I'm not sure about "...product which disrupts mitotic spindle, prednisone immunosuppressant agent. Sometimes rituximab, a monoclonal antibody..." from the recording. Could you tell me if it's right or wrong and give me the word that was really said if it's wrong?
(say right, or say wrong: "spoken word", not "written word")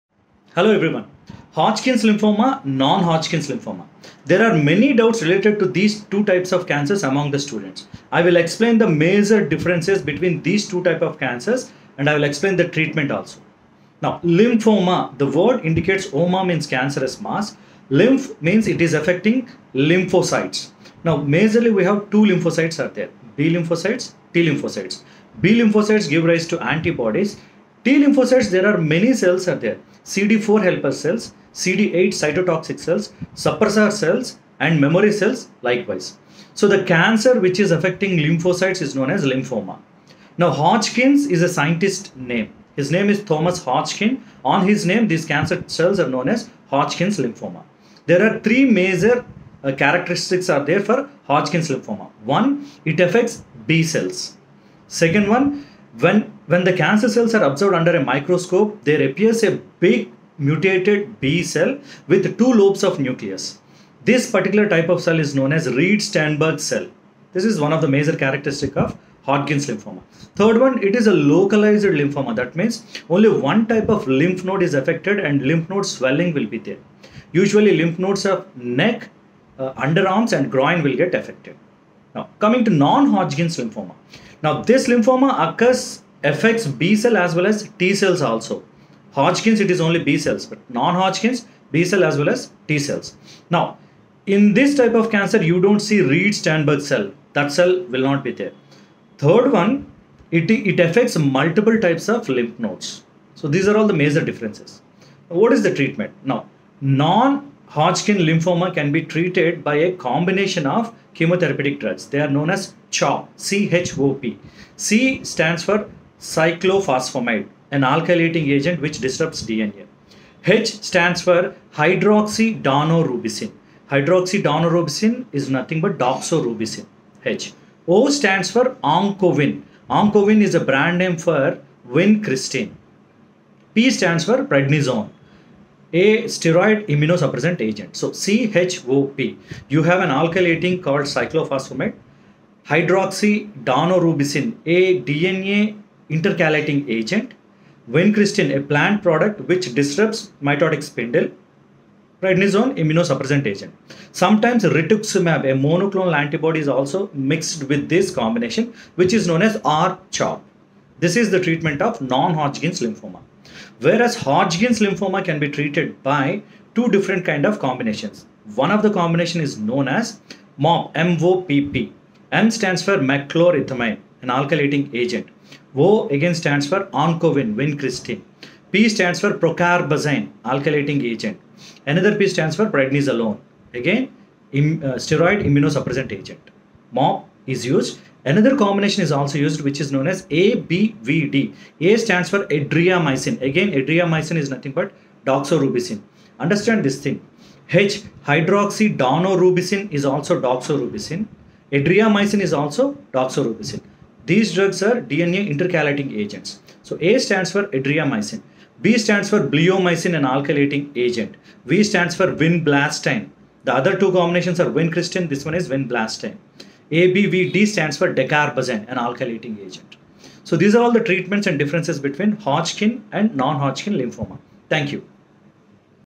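right.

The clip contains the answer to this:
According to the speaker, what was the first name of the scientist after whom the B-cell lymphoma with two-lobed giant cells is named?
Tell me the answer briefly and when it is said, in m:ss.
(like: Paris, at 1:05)
Thomas, at 0:43.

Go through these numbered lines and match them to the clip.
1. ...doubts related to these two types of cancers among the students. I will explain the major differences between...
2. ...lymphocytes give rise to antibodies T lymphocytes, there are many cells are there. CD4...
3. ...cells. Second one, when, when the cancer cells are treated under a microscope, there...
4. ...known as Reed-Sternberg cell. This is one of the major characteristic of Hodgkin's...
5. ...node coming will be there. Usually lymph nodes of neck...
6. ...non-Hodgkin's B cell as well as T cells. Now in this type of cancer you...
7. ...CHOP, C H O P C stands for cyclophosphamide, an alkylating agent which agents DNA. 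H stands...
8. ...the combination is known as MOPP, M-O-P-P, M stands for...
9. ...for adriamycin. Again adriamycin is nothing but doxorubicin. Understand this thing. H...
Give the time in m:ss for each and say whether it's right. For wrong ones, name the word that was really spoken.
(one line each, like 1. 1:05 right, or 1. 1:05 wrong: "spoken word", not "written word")
1. 0:04 right
2. 0:25 right
3. 0:53 wrong: "observed", not "treated"
4. 1:05 right
5. 1:15 wrong: "swelling", not "coming"
6. 1:30 right
7. 1:52 wrong: "disrupts", not "agents"
8. 2:48 right
9. 3:12 right.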